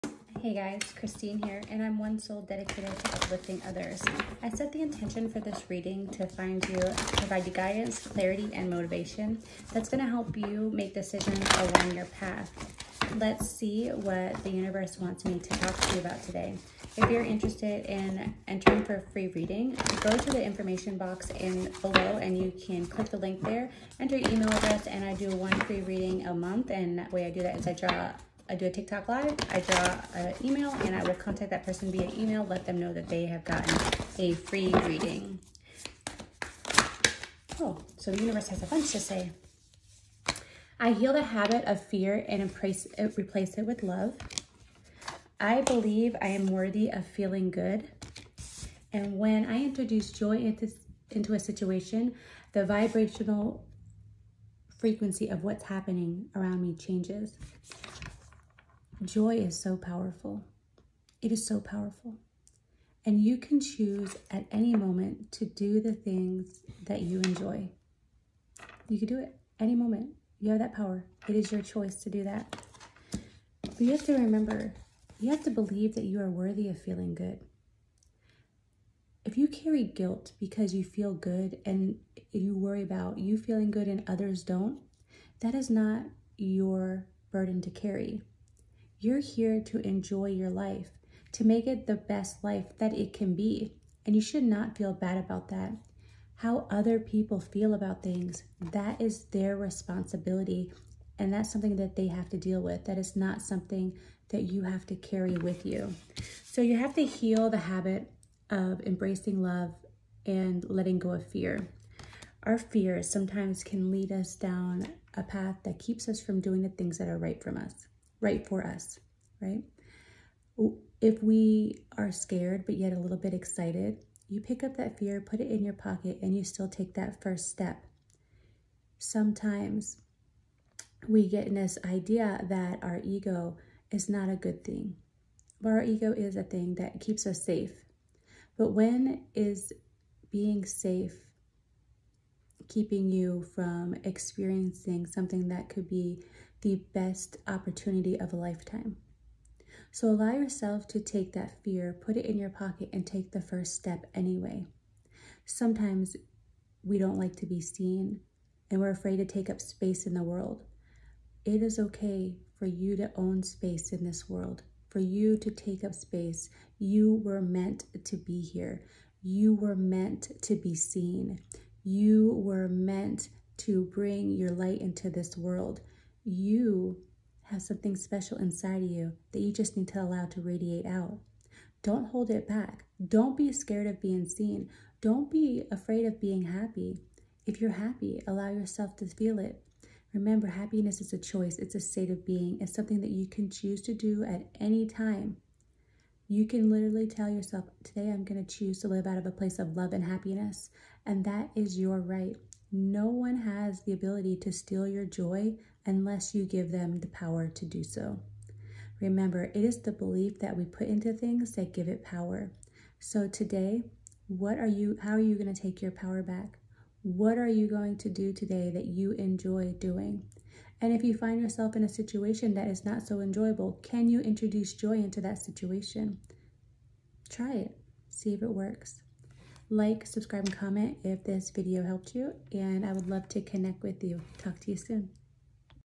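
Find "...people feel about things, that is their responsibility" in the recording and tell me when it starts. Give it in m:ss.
1:36.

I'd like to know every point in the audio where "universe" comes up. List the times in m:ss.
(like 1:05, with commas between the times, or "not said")
0:14, 0:38.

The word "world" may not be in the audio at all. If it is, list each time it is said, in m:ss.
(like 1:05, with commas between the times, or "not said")
2:40, 2:44, 2:55.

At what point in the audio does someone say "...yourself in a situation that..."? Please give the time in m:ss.
3:41.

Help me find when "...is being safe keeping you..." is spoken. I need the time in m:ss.
2:19.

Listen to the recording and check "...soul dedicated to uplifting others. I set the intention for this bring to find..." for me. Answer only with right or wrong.
wrong.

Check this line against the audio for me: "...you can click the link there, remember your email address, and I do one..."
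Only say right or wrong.
wrong.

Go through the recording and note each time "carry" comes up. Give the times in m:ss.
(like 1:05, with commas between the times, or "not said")
1:19, 1:27, 1:44.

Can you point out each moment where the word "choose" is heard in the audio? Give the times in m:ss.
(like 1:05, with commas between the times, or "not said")
1:03, 3:13, 3:18.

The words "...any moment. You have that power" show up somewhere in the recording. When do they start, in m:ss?
1:09.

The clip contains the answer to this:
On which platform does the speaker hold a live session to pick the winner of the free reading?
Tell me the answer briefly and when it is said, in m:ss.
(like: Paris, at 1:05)
TikTok, at 0:28.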